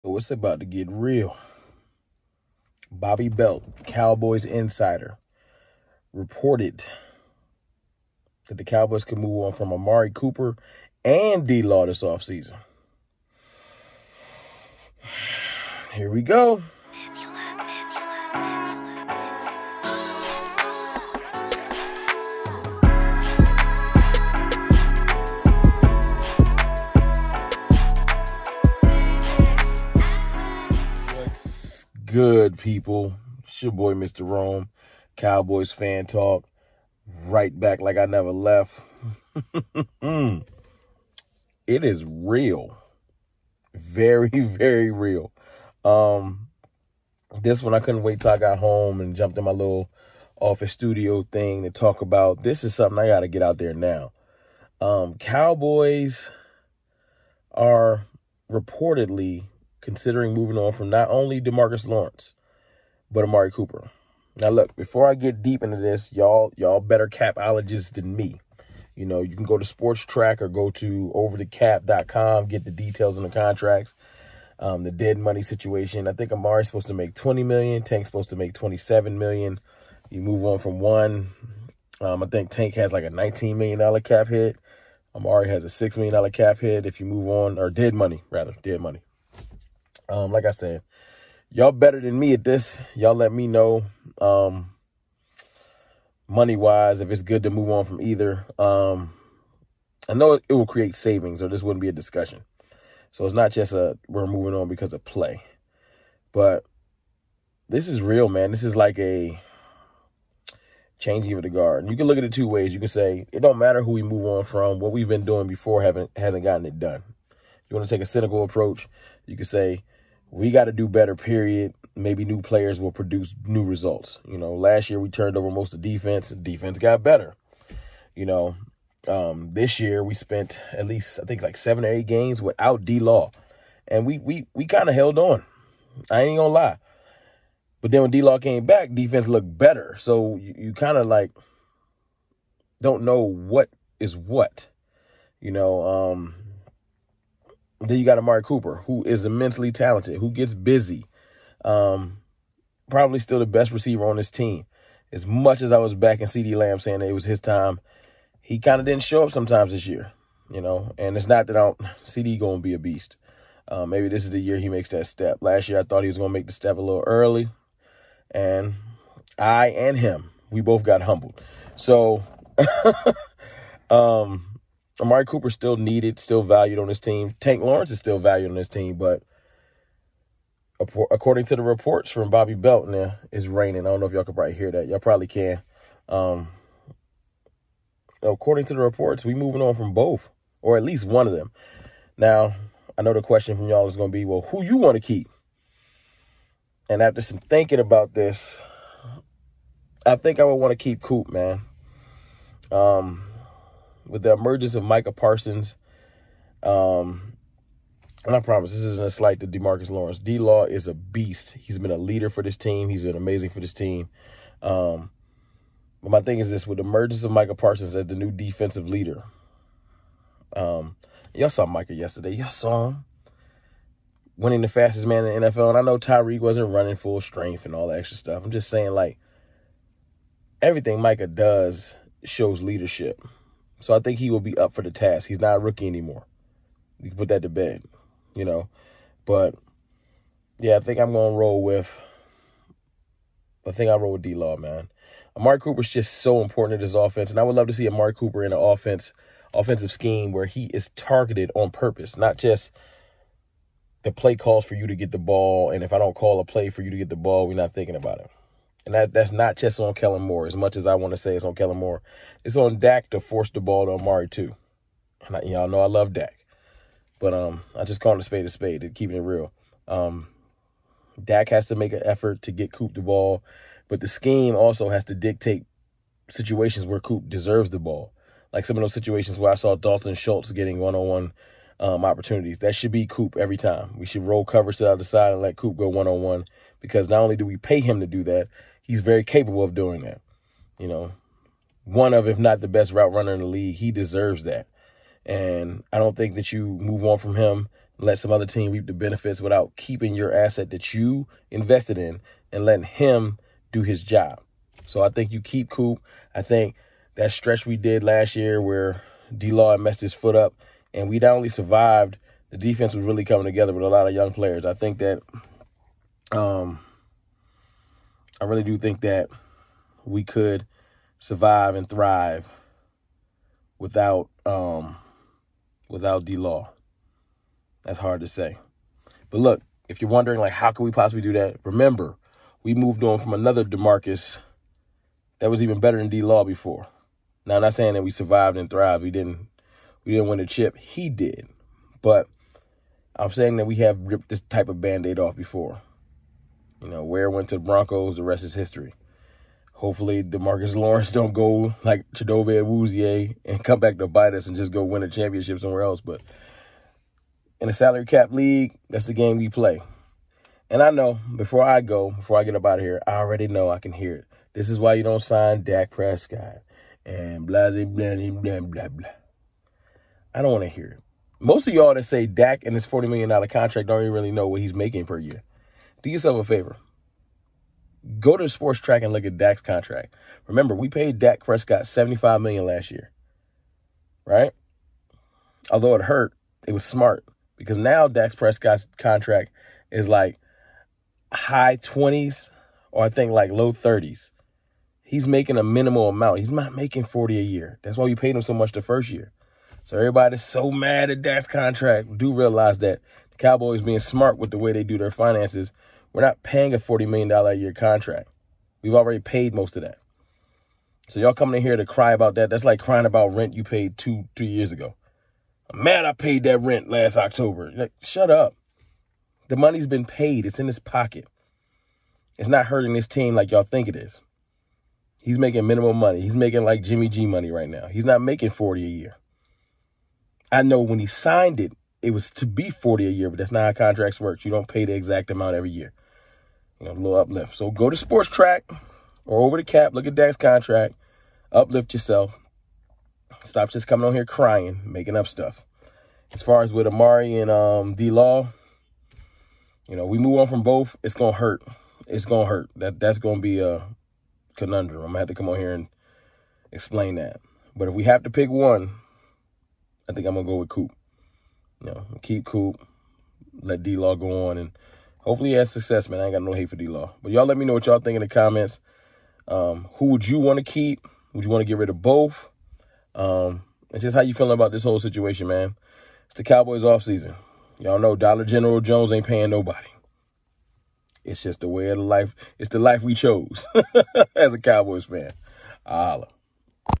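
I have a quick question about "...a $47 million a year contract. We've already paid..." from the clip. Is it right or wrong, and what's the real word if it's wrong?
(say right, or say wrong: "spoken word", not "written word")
wrong: "40", not "47".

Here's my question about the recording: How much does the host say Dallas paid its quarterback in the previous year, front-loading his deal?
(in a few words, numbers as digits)
$75 million.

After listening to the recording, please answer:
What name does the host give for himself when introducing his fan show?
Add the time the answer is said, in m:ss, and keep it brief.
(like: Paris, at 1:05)
Mr. Rome, at 0:33.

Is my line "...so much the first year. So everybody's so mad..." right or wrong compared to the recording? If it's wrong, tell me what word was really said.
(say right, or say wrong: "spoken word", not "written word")
right.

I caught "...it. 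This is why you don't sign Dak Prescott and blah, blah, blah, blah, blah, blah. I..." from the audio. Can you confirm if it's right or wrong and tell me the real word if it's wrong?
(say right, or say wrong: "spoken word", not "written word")
right.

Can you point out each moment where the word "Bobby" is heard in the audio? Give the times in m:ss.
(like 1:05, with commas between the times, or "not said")
0:02, 3:02.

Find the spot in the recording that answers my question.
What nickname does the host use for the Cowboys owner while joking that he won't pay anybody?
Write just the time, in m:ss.
7:58.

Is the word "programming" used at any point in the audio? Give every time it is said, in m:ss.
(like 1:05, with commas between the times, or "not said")
not said.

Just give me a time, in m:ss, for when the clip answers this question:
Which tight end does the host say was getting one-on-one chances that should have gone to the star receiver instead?
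4:39.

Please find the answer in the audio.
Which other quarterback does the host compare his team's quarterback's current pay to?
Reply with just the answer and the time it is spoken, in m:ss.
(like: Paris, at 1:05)
Jimmy G, at 7:06.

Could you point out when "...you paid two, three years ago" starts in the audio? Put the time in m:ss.
6:53.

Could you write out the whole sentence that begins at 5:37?
Now I'm not saying that we survived and thrived.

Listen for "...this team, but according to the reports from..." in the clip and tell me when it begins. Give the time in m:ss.
2:58.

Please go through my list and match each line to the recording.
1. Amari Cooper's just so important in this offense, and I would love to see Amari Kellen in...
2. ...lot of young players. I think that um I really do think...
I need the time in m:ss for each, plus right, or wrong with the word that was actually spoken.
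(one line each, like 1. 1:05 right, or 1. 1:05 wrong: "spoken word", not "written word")
1. 4:05 wrong: "Cooper", not "Kellen"
2. 5:13 right.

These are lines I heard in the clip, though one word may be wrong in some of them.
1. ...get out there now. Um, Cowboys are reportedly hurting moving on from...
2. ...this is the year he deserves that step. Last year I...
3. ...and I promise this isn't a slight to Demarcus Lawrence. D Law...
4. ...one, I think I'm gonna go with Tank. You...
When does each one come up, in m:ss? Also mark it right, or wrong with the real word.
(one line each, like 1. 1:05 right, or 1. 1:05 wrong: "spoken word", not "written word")
1. 0:53 wrong: "considering", not "hurting"
2. 2:44 wrong: "makes", not "deserves"
3. 3:28 right
4. 7:38 wrong: "Coop", not "Tank".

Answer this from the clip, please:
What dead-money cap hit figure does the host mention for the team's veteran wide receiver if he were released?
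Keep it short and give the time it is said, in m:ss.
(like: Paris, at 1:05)
$6 million, at 1:25.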